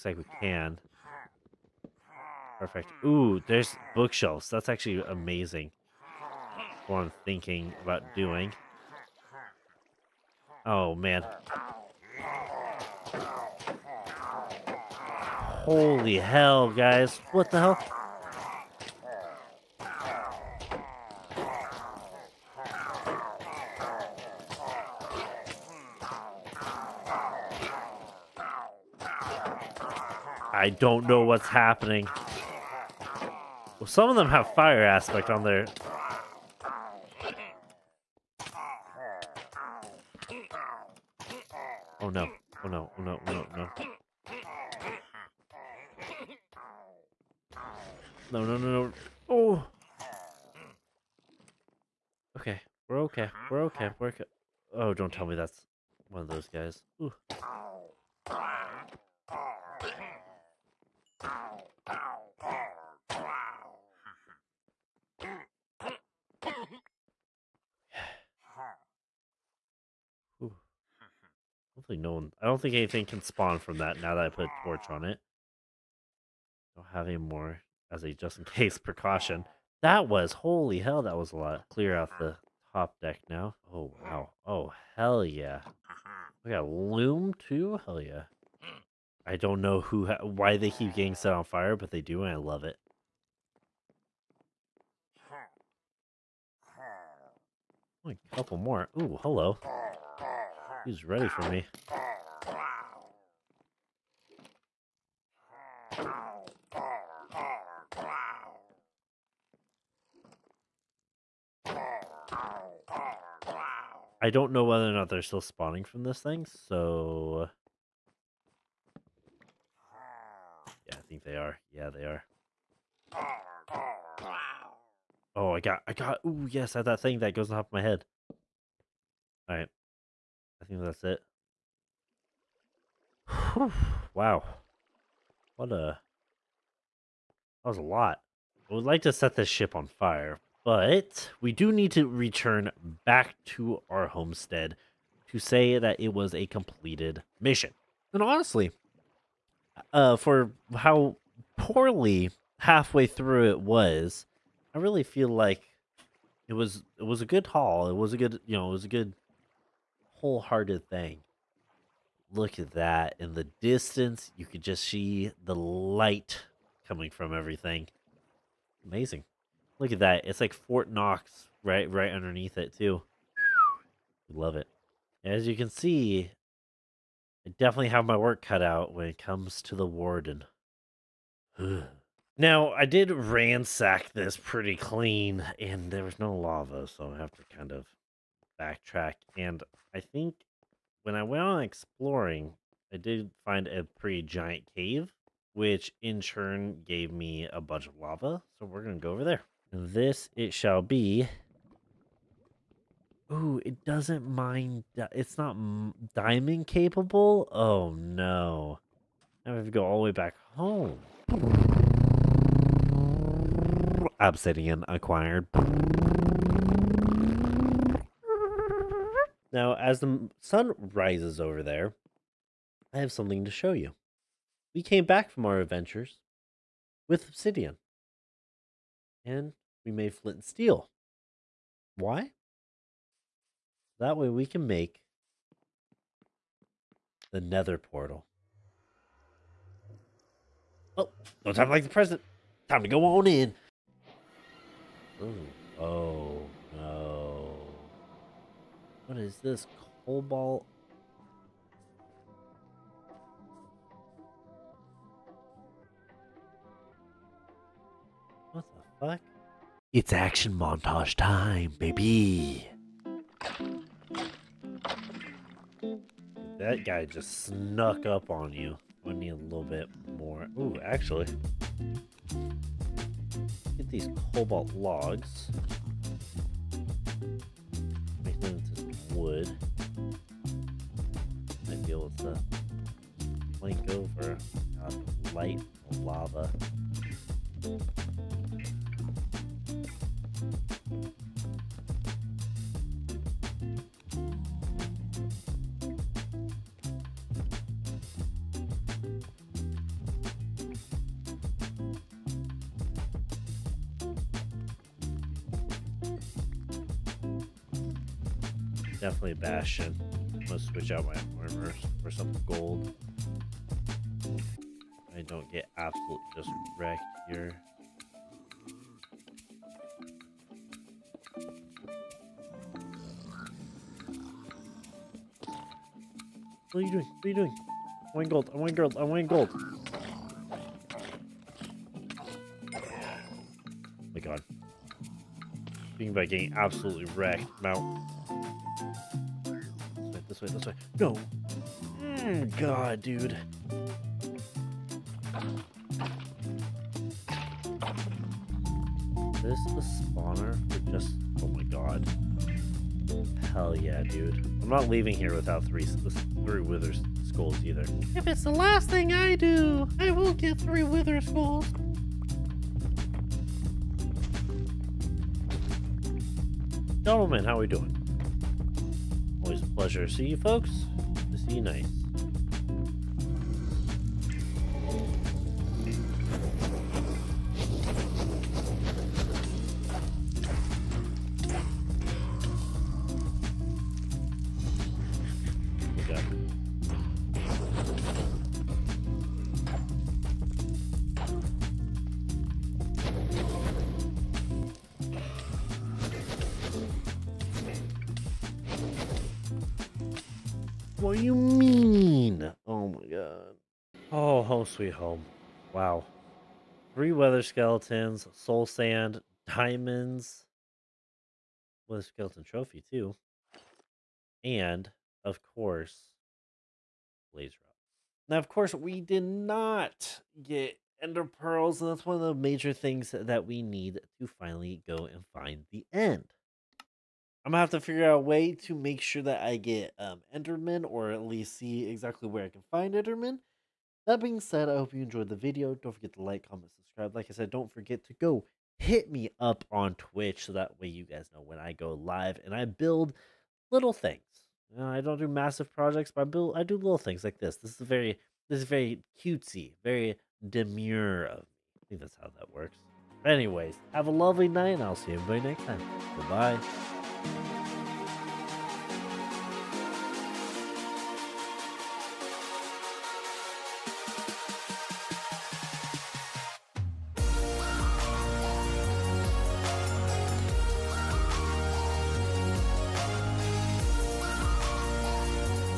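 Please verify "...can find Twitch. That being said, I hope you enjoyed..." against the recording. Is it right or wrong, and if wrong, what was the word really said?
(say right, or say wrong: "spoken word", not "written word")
wrong: "Enderman", not "Twitch".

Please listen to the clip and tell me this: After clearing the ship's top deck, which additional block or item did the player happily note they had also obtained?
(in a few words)
Loom.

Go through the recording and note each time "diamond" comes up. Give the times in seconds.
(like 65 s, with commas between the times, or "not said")
206 s, 409 s.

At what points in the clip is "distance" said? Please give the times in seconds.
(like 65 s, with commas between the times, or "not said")
163 s.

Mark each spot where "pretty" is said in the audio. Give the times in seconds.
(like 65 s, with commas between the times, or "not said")
184 s, 193 s.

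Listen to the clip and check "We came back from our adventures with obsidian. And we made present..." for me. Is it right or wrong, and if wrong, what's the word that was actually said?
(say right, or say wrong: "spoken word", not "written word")
wrong: "flint", not "present".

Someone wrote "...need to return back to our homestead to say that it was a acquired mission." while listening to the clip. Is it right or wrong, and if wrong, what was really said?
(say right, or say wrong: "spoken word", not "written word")
wrong: "completed", not "acquired".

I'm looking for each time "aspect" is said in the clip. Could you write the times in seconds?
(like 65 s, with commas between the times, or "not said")
34 s.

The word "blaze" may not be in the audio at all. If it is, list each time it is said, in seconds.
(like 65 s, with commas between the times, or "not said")
417 s.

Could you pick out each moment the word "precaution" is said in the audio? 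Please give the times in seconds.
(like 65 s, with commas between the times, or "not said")
78 s.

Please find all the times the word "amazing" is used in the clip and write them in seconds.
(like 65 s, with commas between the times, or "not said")
5 s, 168 s.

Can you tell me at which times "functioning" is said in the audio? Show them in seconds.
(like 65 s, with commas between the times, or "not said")
not said.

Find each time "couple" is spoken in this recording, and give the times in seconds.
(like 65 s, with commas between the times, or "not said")
98 s.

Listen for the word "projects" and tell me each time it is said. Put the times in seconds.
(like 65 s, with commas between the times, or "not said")
445 s.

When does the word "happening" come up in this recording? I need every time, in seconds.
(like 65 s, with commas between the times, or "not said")
31 s.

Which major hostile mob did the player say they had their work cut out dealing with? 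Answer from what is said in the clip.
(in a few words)
The warden.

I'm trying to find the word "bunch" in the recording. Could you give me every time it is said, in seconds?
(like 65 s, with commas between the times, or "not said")
197 s.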